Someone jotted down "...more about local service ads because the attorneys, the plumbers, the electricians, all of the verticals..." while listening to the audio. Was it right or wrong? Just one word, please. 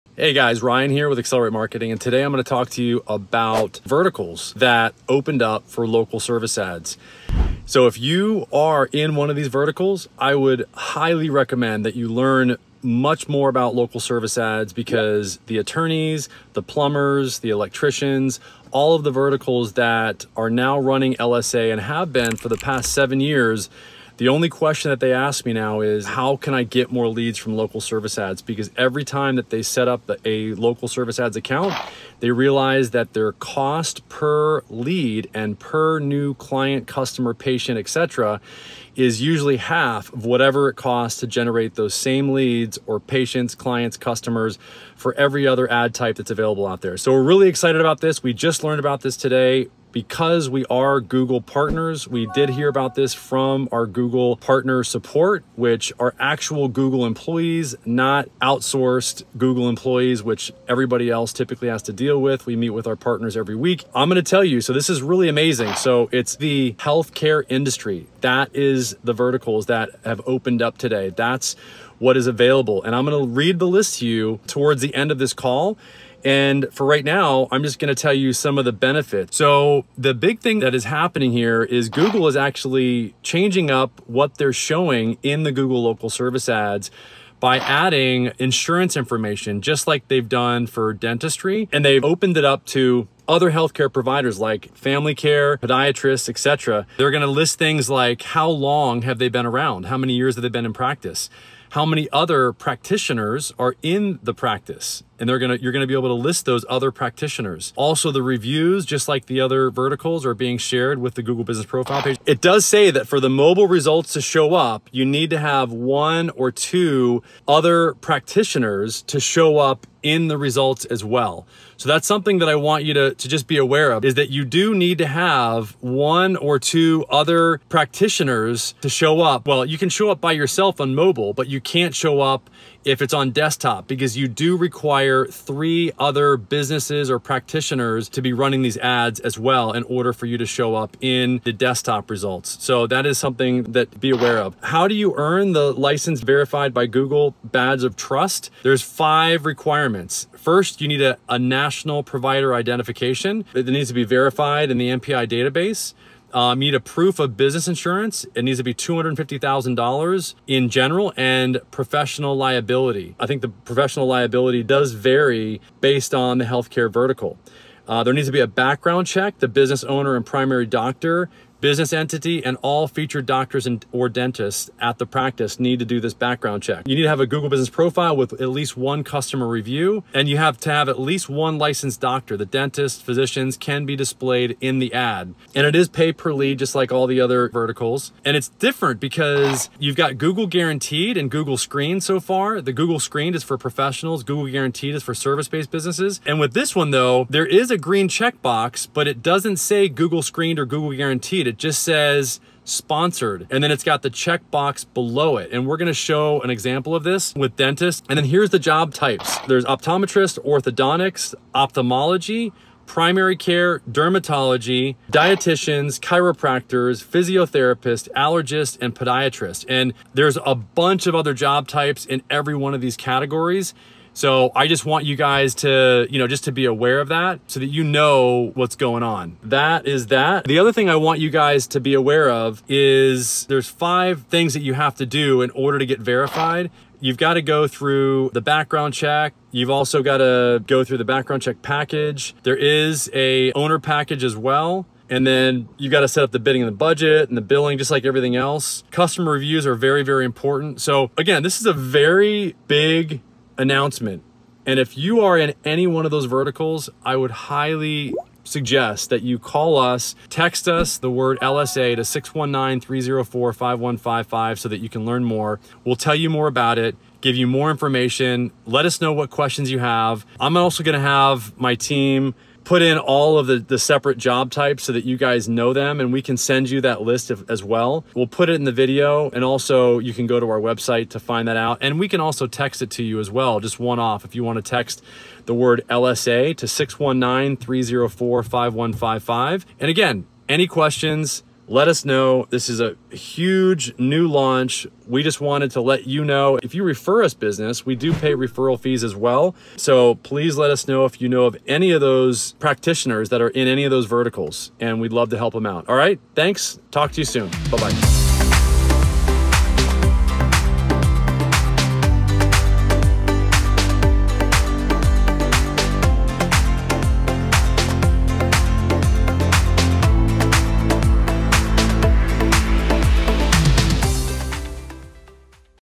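right.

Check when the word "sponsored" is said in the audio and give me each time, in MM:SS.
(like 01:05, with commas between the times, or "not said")
03:22.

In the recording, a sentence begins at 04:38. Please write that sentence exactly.
We'll put it in the video and also you can go to our website to find that out.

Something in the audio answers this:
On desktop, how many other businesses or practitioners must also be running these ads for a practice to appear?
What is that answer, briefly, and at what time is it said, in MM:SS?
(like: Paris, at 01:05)
3, at 02:15.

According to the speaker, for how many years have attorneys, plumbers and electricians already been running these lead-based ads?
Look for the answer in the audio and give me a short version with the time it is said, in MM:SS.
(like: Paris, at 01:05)
7 years, at 00:22.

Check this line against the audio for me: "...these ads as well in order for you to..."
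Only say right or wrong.
right.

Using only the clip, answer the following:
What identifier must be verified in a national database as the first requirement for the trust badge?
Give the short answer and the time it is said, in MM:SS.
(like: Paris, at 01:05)
National provider identification, at 02:31.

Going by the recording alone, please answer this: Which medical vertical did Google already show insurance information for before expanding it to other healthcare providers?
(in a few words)
Dentistry.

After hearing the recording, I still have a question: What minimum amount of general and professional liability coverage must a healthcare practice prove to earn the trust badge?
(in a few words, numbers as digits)
$250,000.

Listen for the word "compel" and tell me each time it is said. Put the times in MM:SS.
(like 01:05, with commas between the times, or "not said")
not said.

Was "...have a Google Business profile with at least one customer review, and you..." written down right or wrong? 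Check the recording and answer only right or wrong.
right.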